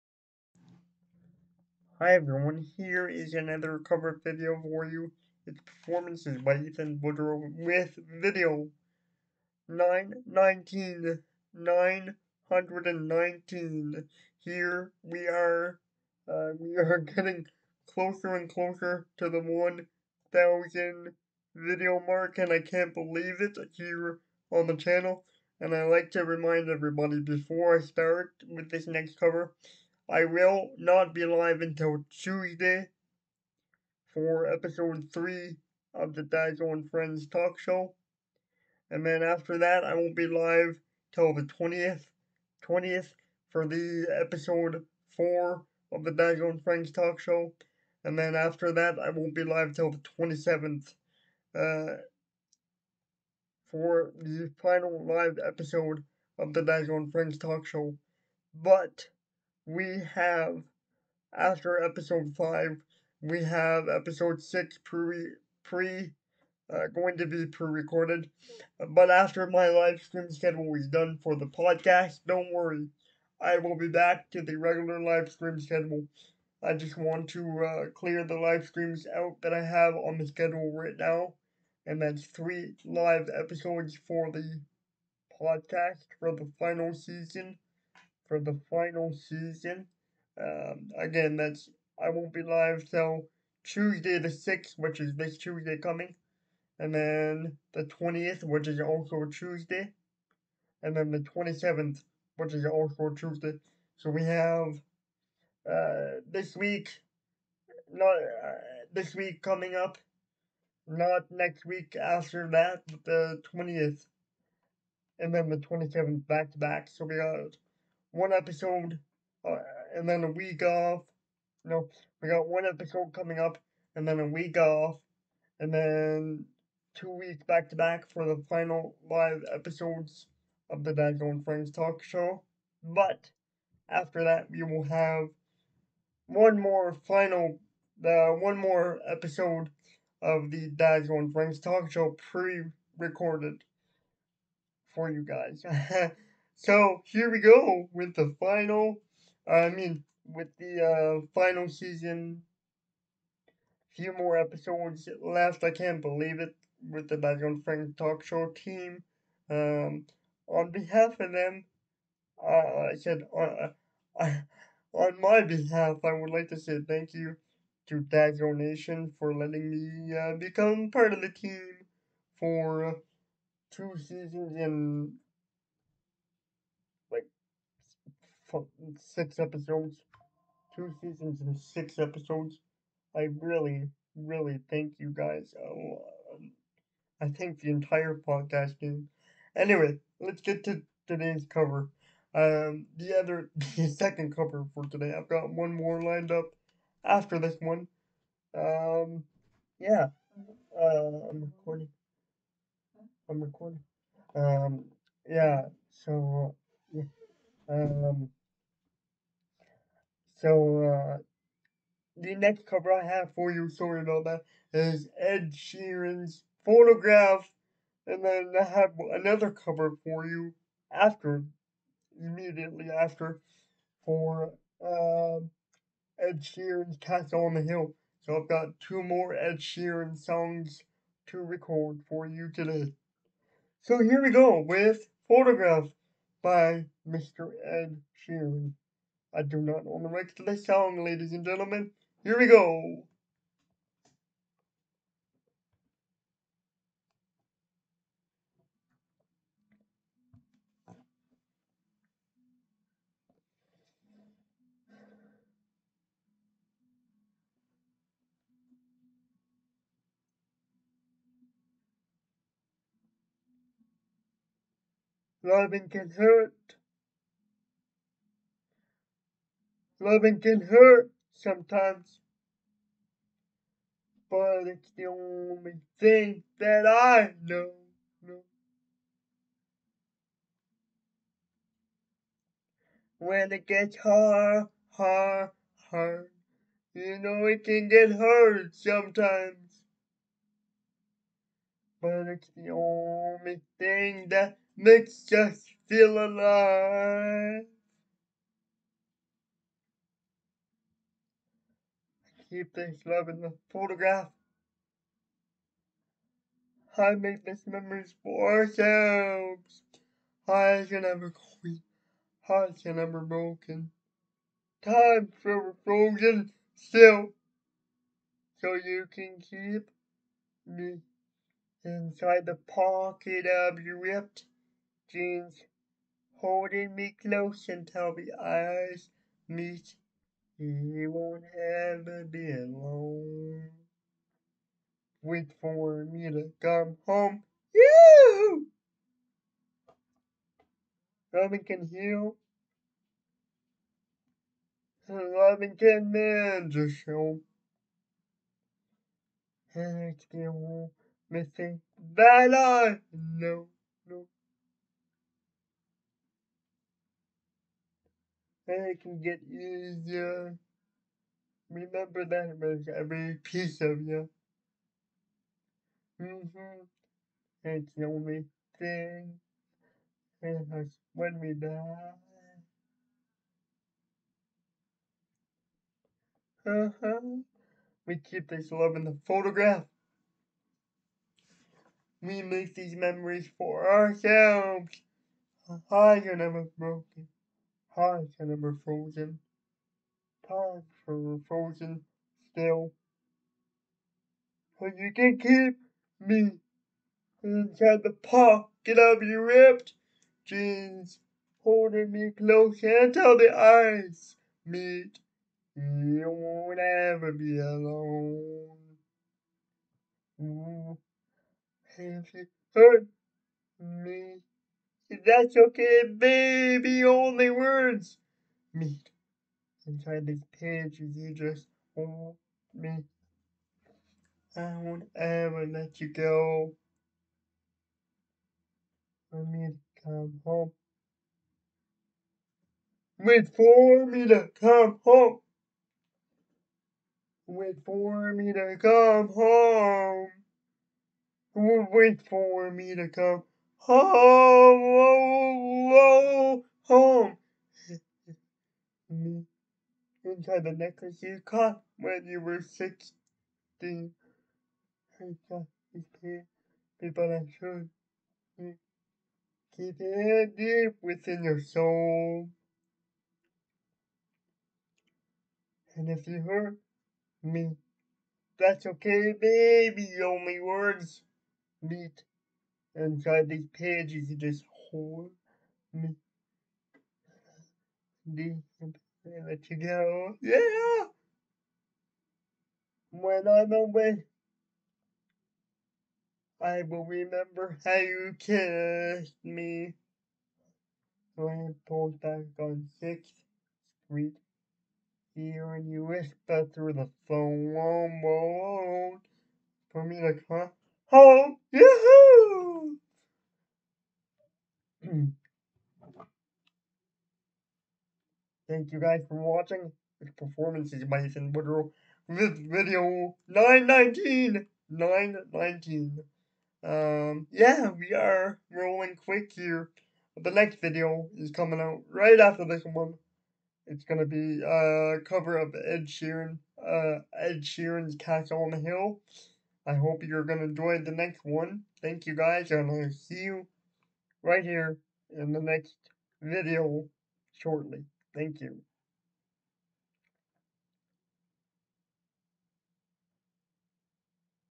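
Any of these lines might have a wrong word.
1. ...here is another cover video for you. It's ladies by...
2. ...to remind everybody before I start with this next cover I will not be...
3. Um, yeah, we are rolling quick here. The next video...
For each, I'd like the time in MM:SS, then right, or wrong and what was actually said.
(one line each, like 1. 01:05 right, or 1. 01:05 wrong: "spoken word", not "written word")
1. 00:02 wrong: "performances", not "ladies"
2. 00:26 right
3. 08:36 right.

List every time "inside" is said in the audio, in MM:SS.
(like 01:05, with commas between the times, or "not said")
05:21, 06:37, 06:59, 07:30, 07:52.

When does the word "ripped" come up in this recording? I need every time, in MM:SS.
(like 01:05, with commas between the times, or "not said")
05:24, 06:39.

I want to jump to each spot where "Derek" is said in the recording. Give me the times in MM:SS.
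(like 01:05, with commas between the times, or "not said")
not said.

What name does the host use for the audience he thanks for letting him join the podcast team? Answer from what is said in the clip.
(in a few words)
Dazzle Nation.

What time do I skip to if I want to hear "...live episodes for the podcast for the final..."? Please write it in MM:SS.
01:22.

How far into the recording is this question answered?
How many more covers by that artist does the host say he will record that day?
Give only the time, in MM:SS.
03:48.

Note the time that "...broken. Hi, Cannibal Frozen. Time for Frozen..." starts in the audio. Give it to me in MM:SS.
06:26.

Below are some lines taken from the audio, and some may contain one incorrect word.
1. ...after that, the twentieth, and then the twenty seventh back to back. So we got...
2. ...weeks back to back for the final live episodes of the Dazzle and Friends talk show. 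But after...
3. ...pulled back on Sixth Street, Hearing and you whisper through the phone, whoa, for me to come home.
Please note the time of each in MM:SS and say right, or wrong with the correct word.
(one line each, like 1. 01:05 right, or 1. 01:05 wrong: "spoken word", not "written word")
1. 01:52 right
2. 02:07 wrong: "Dad", not "Dazzle"
3. 08:11 right.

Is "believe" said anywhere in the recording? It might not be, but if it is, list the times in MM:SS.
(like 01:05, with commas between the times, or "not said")
00:22, 02:36.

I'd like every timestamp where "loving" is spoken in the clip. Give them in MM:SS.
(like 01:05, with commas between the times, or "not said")
04:25, 04:30.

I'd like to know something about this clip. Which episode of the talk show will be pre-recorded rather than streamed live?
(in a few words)
6.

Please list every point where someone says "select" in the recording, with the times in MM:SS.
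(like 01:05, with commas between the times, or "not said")
not said.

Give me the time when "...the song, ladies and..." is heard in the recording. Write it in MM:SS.
04:00.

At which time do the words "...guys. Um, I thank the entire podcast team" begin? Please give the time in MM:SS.
03:05.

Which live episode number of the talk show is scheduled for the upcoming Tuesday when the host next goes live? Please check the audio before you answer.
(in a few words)
3.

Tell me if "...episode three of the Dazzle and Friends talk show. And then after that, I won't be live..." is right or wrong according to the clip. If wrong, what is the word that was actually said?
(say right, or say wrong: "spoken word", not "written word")
wrong: "four", not "three".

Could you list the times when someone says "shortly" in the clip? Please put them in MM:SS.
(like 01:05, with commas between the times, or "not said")
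08:57.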